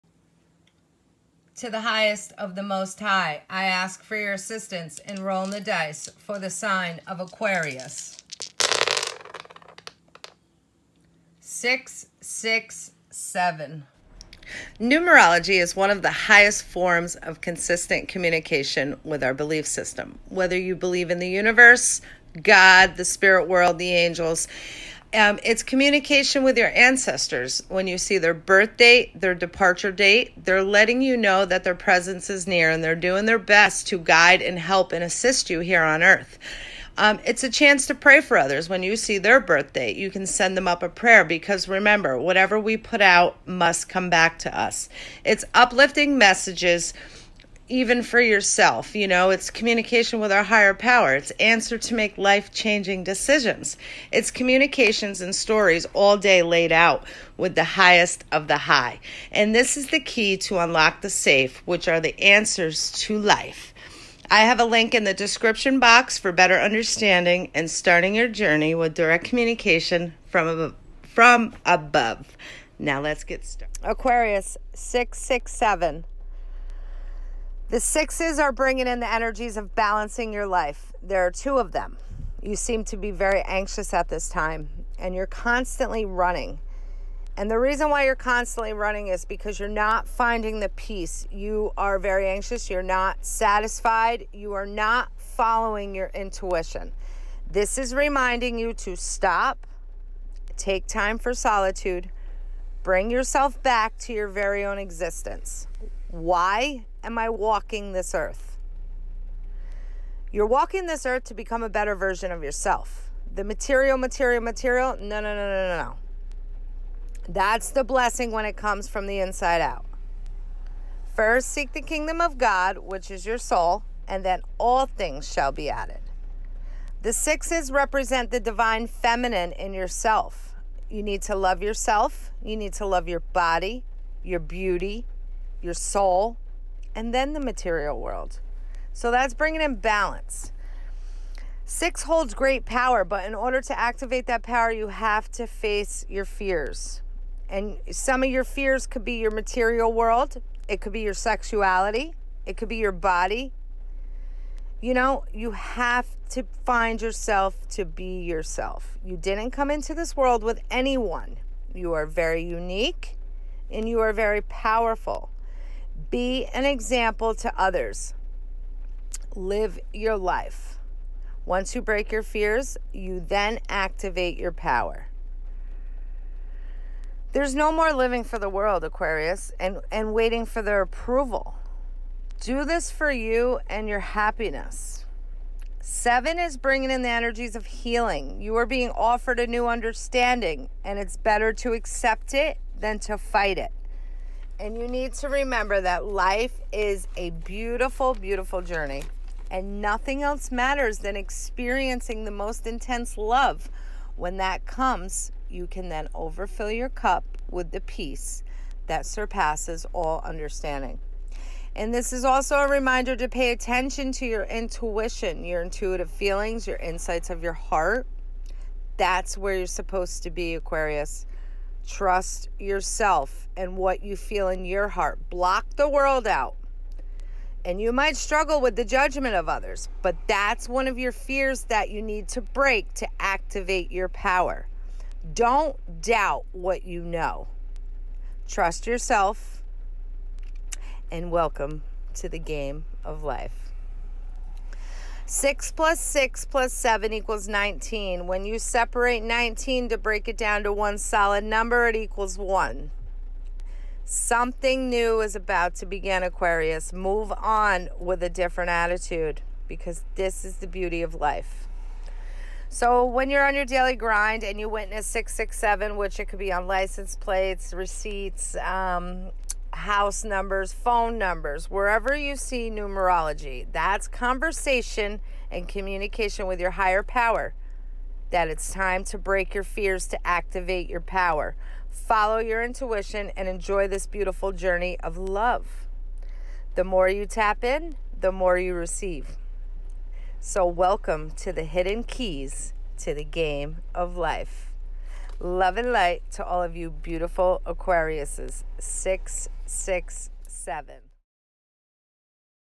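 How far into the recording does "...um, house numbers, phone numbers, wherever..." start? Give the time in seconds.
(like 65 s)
268 s.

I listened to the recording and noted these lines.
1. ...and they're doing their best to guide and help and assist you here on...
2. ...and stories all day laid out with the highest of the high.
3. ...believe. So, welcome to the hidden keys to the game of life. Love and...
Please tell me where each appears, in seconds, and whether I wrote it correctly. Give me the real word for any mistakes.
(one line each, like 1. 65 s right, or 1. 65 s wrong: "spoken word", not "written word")
1. 32 s right
2. 55 s right
3. 288 s wrong: "receive", not "believe".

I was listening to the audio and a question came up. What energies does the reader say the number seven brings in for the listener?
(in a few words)
healing.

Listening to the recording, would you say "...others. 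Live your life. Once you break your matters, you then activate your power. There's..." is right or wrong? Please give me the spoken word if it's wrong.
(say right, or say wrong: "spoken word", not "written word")
wrong: "fears", not "matters".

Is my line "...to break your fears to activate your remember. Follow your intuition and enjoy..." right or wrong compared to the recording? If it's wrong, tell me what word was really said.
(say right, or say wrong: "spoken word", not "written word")
wrong: "power", not "remember".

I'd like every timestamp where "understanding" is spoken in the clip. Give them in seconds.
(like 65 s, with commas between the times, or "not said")
66 s, 189 s, 210 s.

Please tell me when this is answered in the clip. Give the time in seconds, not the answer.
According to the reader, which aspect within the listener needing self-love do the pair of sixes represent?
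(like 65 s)
128 s.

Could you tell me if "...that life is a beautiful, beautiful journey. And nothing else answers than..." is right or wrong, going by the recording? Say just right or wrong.
wrong.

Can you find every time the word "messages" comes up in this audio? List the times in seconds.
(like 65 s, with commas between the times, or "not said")
46 s.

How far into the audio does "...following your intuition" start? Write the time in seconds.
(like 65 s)
95 s.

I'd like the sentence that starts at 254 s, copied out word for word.
Something new is about to begin, Aquarius.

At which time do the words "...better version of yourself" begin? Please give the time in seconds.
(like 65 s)
111 s.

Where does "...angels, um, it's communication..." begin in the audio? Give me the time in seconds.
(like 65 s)
23 s.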